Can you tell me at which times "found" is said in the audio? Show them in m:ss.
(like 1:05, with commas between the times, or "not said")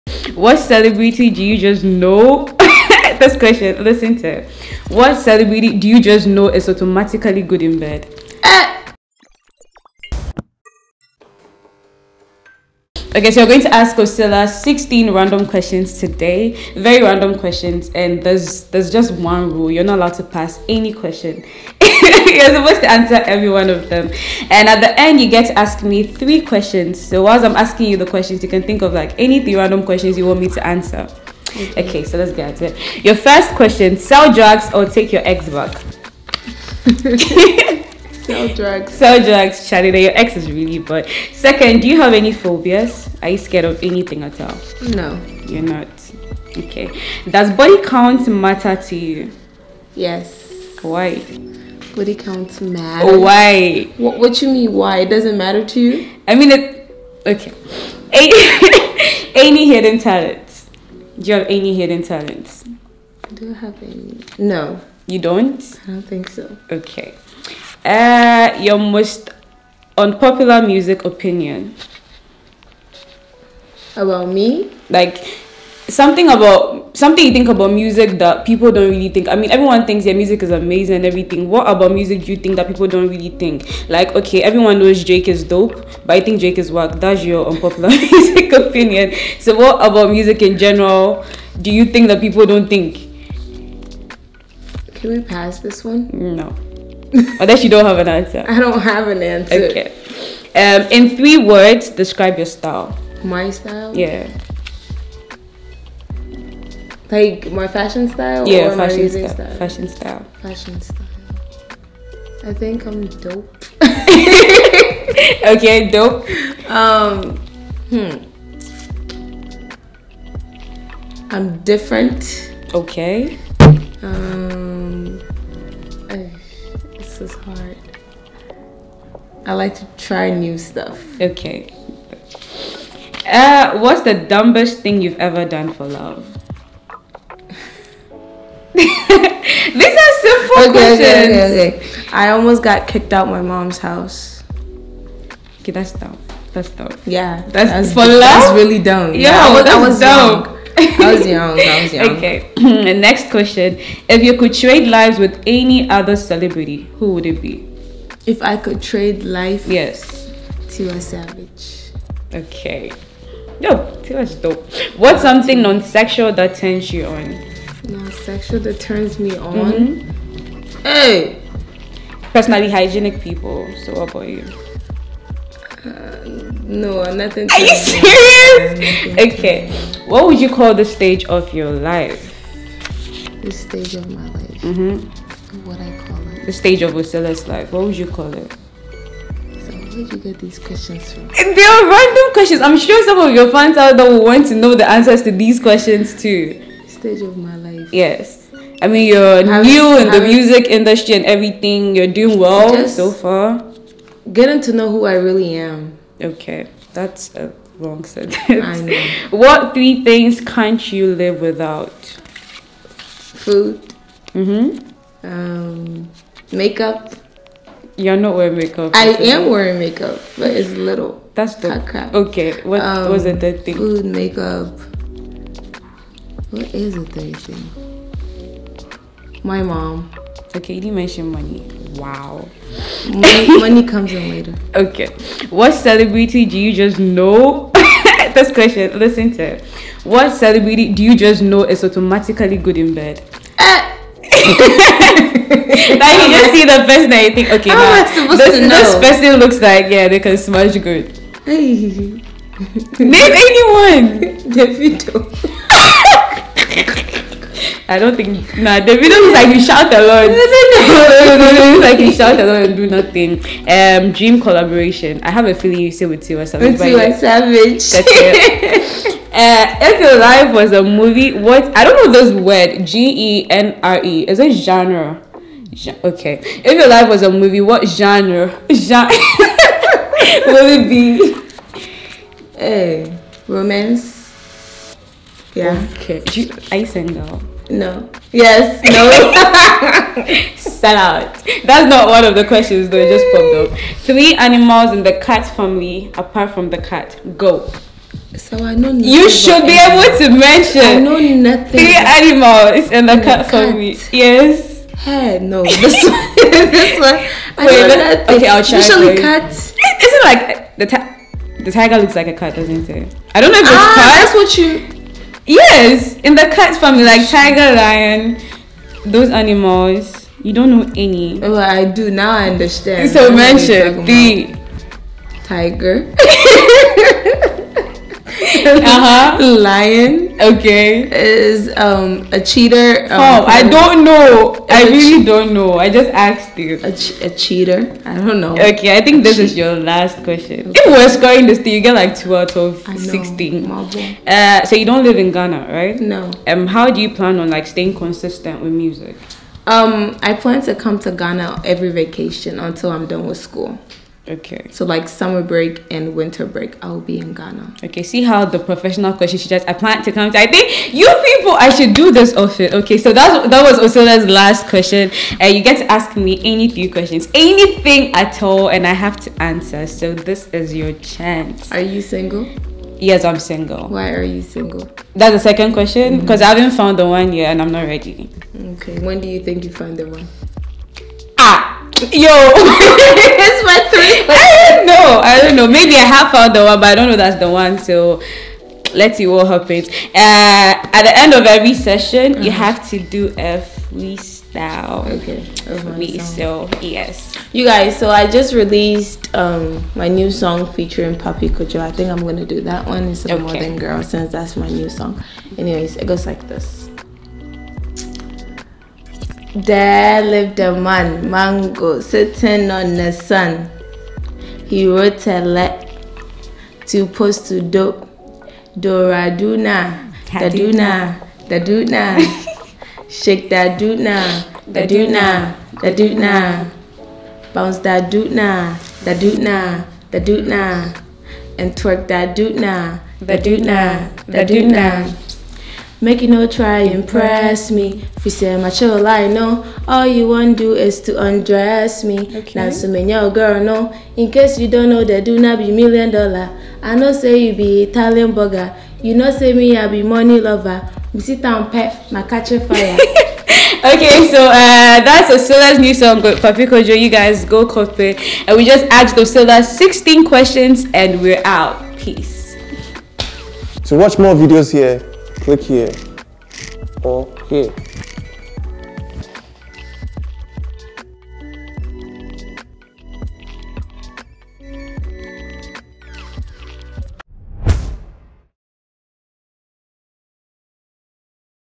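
6:16, 6:26.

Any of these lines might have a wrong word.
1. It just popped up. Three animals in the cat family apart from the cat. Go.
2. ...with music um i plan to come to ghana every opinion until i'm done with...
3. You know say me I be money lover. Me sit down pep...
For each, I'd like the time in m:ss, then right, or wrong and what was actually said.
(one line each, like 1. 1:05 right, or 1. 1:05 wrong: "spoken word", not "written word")
1. 4:52 right
2. 5:48 wrong: "vacation", not "opinion"
3. 7:29 right.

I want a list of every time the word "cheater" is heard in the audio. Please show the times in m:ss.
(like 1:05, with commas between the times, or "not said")
5:32, 5:37.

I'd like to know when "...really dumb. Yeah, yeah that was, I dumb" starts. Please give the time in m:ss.
2:28.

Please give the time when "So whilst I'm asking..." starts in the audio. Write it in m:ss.
0:27.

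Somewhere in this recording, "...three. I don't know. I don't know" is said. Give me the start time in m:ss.
6:23.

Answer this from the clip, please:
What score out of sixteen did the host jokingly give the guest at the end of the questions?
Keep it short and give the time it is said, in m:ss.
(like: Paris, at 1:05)
2, at 5:42.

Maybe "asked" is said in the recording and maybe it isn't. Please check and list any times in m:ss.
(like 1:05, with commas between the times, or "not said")
5:36, 7:38.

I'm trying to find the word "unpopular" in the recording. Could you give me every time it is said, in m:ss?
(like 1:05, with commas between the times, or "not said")
1:09, 1:27.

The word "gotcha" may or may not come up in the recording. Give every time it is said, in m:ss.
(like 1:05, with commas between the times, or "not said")
not said.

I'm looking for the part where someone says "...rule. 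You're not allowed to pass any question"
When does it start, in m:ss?
0:19.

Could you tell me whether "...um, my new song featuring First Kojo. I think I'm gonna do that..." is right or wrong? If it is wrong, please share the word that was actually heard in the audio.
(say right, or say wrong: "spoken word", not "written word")
wrong: "Pappy", not "First".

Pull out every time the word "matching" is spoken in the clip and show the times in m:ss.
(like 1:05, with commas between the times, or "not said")
not said.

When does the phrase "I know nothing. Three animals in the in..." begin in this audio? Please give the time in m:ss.
5:00.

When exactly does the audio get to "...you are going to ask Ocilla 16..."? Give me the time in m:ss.
0:13.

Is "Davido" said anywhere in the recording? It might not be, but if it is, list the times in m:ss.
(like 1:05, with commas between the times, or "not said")
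4:14, 4:18.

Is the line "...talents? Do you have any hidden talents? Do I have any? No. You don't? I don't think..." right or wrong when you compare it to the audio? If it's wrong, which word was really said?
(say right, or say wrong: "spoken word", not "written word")
right.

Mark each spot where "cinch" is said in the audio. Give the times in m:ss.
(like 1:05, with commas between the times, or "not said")
not said.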